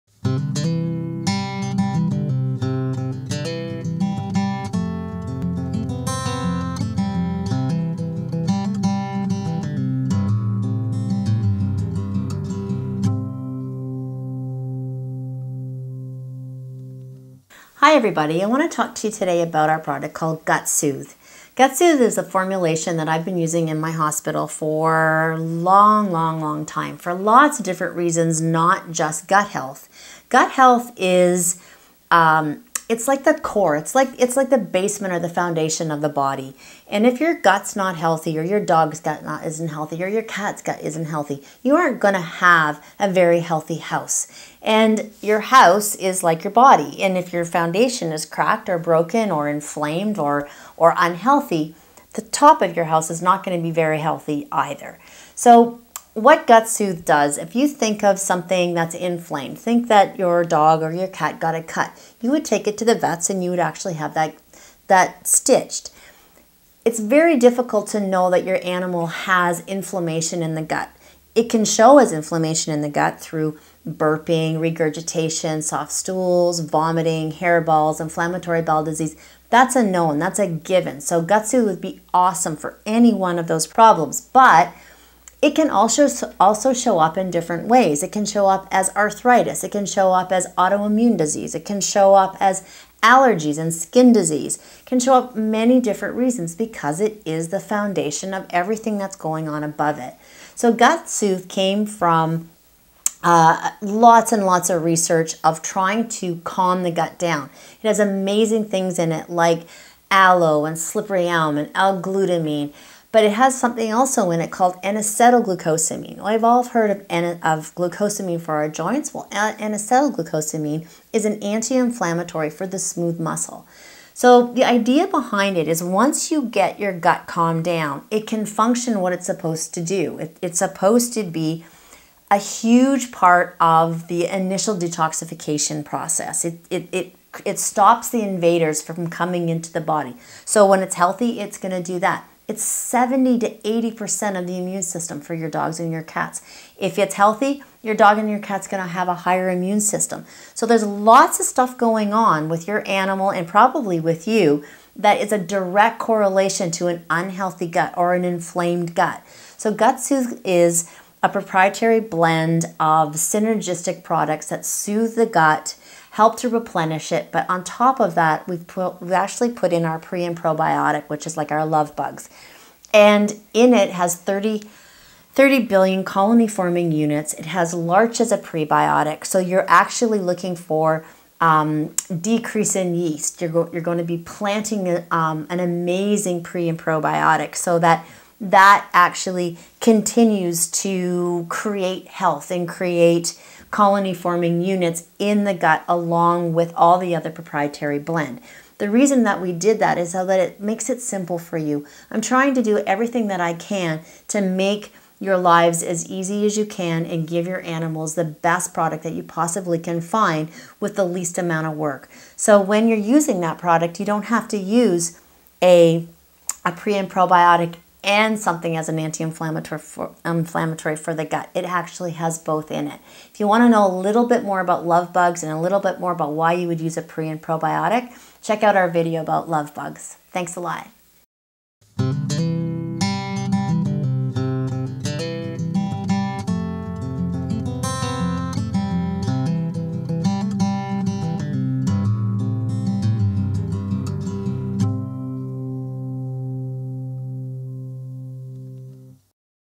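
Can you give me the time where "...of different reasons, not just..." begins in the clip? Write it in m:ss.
0:27.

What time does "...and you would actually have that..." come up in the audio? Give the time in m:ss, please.
1:03.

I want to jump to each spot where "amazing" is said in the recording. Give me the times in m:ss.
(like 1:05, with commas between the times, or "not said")
1:47, 3:05.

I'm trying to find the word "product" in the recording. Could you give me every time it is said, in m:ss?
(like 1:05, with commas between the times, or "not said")
0:19, 2:44, 3:28, 3:33.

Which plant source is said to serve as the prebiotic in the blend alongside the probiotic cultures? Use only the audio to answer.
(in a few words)
larch.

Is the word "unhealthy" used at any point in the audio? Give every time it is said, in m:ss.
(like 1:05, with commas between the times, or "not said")
0:50, 2:37.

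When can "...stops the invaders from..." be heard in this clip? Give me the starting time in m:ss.
2:17.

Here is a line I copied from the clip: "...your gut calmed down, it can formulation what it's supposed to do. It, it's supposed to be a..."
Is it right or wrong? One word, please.
wrong.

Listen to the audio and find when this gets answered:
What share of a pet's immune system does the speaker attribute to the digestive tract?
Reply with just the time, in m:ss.
2:22.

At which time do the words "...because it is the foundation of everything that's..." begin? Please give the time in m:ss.
1:36.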